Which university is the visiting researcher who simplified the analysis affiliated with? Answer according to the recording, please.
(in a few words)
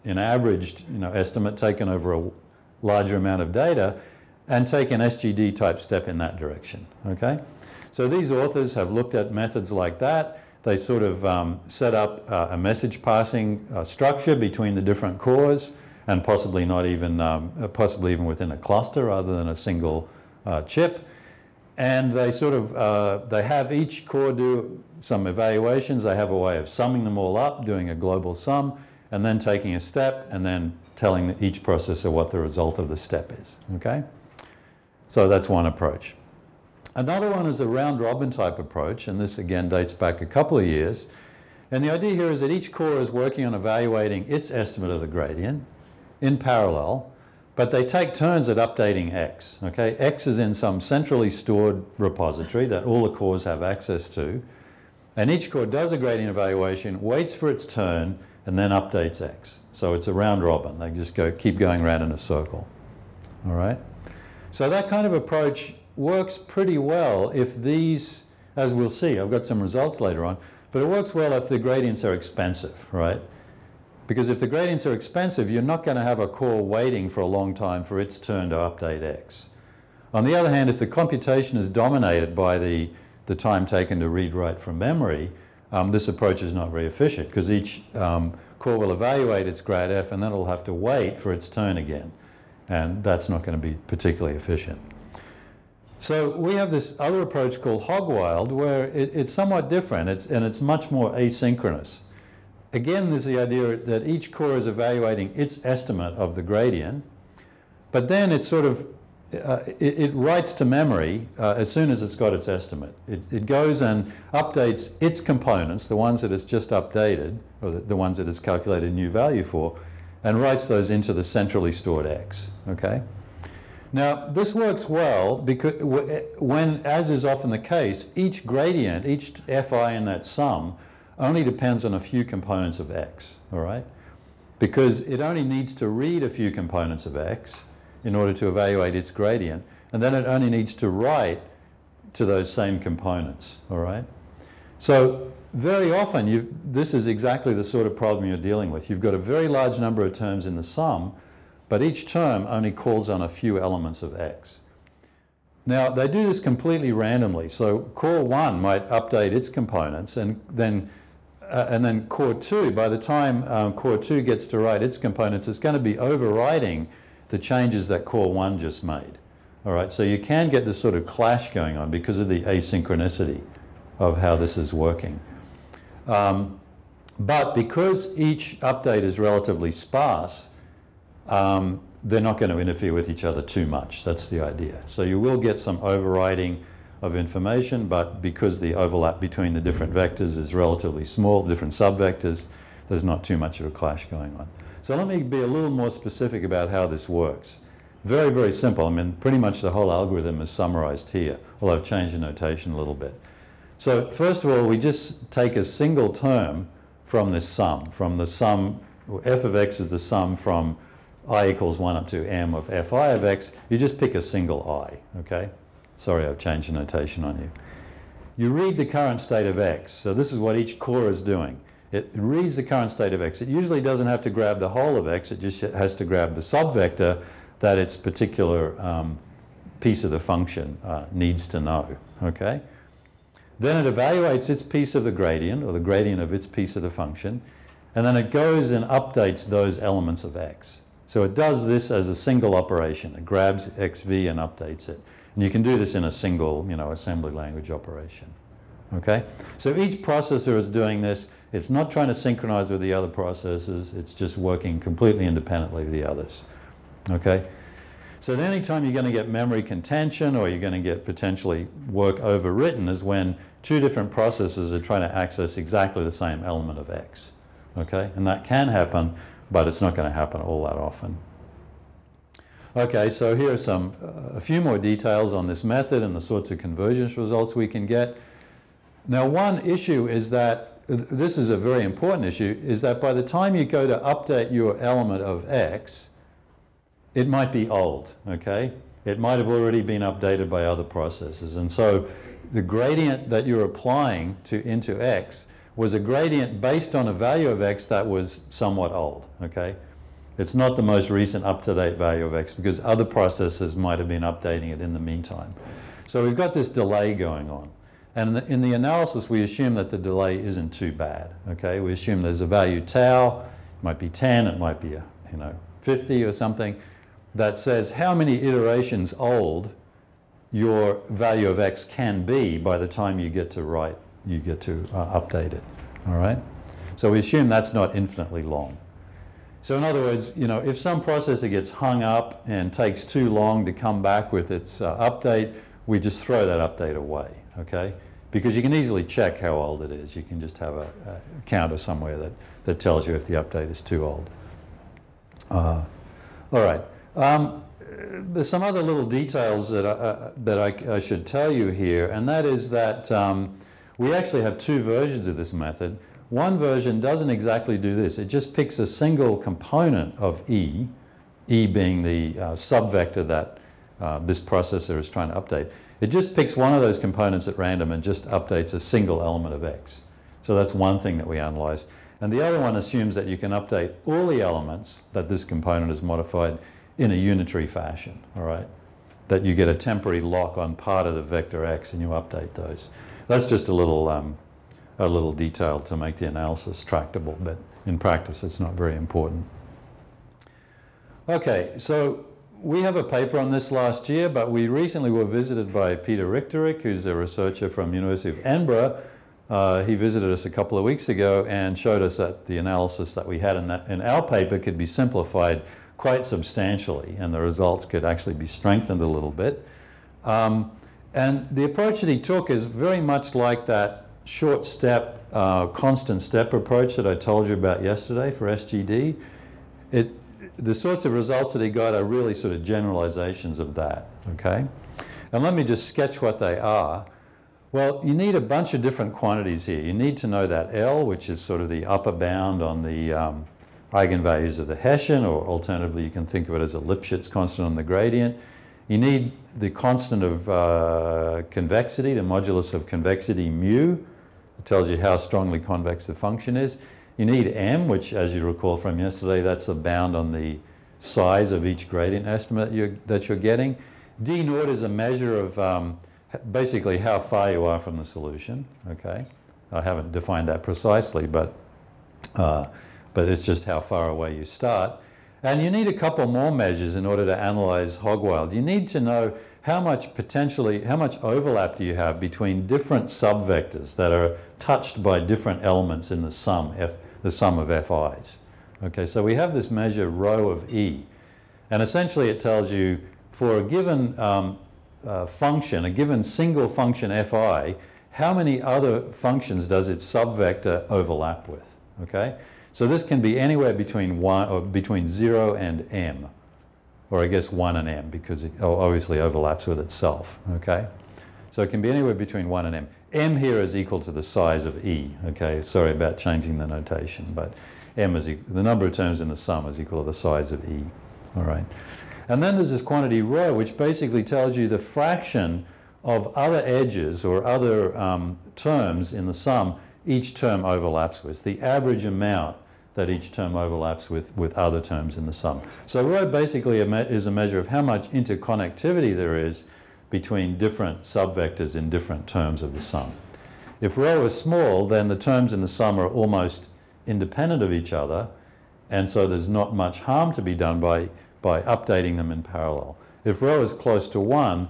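University of Edinburgh.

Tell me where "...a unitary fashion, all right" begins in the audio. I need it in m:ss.
6:17.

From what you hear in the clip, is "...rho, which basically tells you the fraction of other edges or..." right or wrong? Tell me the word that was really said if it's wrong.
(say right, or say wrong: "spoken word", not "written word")
right.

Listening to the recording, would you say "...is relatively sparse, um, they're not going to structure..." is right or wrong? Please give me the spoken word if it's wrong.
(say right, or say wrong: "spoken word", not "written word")
wrong: "interfere", not "structure".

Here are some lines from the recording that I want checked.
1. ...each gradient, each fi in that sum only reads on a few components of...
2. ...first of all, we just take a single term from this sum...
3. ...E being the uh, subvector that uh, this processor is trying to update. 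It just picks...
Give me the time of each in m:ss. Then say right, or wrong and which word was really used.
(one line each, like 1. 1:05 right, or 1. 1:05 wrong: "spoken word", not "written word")
1. 2:08 wrong: "depends", not "reads"
2. 3:24 right
3. 6:01 right.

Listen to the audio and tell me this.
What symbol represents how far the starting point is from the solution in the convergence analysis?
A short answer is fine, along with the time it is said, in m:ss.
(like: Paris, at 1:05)
d naught, at 7:34.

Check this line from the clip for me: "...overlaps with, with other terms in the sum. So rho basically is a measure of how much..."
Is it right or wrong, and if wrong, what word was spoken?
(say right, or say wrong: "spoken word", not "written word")
right.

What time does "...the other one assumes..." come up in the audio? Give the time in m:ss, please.
6:12.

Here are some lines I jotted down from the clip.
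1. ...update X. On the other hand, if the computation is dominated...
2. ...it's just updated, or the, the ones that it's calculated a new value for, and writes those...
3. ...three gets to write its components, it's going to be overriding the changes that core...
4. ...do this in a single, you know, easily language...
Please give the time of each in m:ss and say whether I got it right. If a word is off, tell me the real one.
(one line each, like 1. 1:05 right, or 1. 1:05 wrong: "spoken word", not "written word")
1. 1:18 right
2. 1:56 right
3. 2:43 wrong: "two", not "three"
4. 4:05 wrong: "assembly", not "easily".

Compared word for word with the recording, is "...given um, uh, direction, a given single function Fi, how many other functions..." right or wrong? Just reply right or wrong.
wrong.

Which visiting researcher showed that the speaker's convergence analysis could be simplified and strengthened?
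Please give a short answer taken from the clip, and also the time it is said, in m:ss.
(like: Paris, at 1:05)
Peter Richtárik, at 6:35.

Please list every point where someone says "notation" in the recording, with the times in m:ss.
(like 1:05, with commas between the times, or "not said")
3:22, 3:36, 8:26.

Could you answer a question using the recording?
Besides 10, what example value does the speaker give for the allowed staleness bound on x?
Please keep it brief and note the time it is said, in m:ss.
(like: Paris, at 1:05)
50, at 5:15.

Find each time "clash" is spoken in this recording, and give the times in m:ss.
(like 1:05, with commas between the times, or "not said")
2:51, 3:13.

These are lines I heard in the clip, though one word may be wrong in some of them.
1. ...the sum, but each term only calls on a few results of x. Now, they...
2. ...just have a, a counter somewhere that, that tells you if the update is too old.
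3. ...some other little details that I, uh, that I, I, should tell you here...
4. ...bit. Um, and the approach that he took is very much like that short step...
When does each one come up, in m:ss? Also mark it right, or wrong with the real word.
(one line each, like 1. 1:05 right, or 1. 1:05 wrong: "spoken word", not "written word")
1. 2:30 wrong: "elements", not "results"
2. 5:40 right
3. 5:48 right
4. 6:49 right.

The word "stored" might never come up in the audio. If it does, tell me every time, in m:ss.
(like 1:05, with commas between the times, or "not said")
0:51, 2:01.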